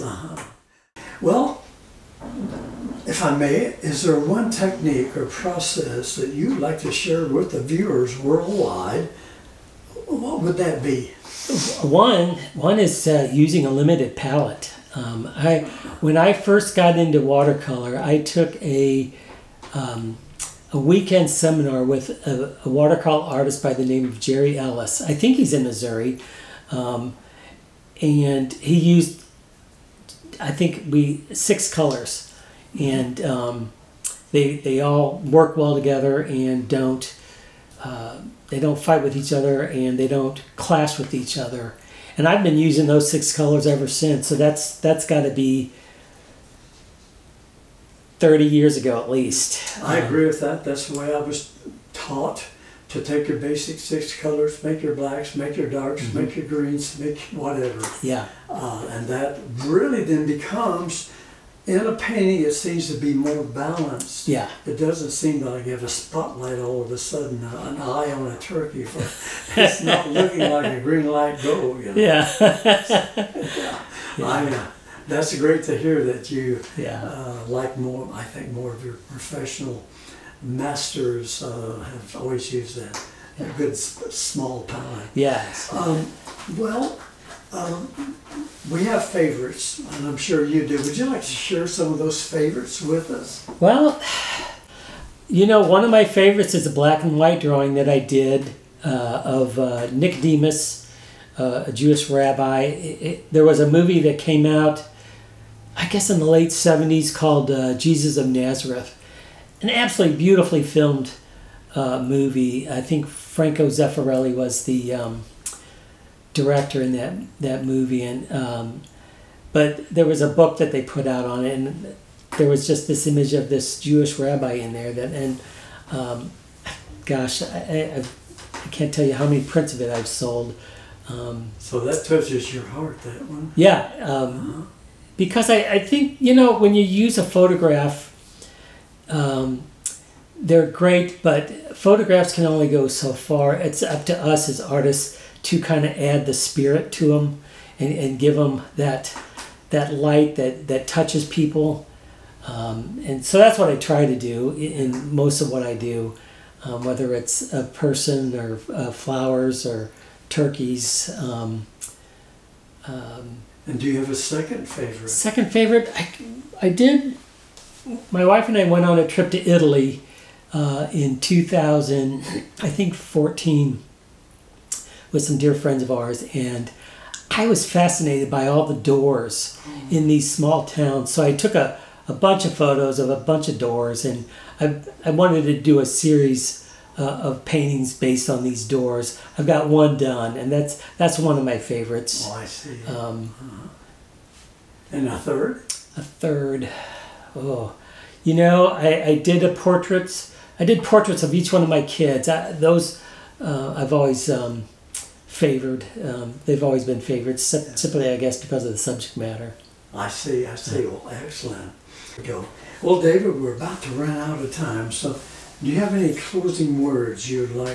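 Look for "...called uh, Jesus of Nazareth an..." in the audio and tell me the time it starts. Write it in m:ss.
1:47.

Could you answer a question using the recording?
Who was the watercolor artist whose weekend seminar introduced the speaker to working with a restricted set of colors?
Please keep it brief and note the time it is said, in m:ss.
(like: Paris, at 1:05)
Jerry Ellis, at 0:24.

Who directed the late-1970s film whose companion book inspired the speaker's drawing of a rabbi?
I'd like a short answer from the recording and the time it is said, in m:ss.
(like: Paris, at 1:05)
Franco Zeffirelli, at 1:53.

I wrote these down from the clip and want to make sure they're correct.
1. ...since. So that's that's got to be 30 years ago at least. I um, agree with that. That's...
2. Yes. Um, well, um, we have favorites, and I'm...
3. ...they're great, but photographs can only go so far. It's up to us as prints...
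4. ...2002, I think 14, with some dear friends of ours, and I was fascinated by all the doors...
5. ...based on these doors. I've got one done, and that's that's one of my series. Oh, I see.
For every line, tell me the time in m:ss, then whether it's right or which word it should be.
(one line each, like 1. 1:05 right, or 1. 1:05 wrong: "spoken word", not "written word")
1. 0:43 right
2. 1:25 right
3. 2:20 wrong: "artists", not "prints"
4. 2:51 wrong: "2000", not "2002"
5. 3:07 wrong: "favorites", not "series".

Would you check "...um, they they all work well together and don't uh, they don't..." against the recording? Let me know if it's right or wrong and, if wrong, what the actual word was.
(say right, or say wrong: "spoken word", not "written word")
right.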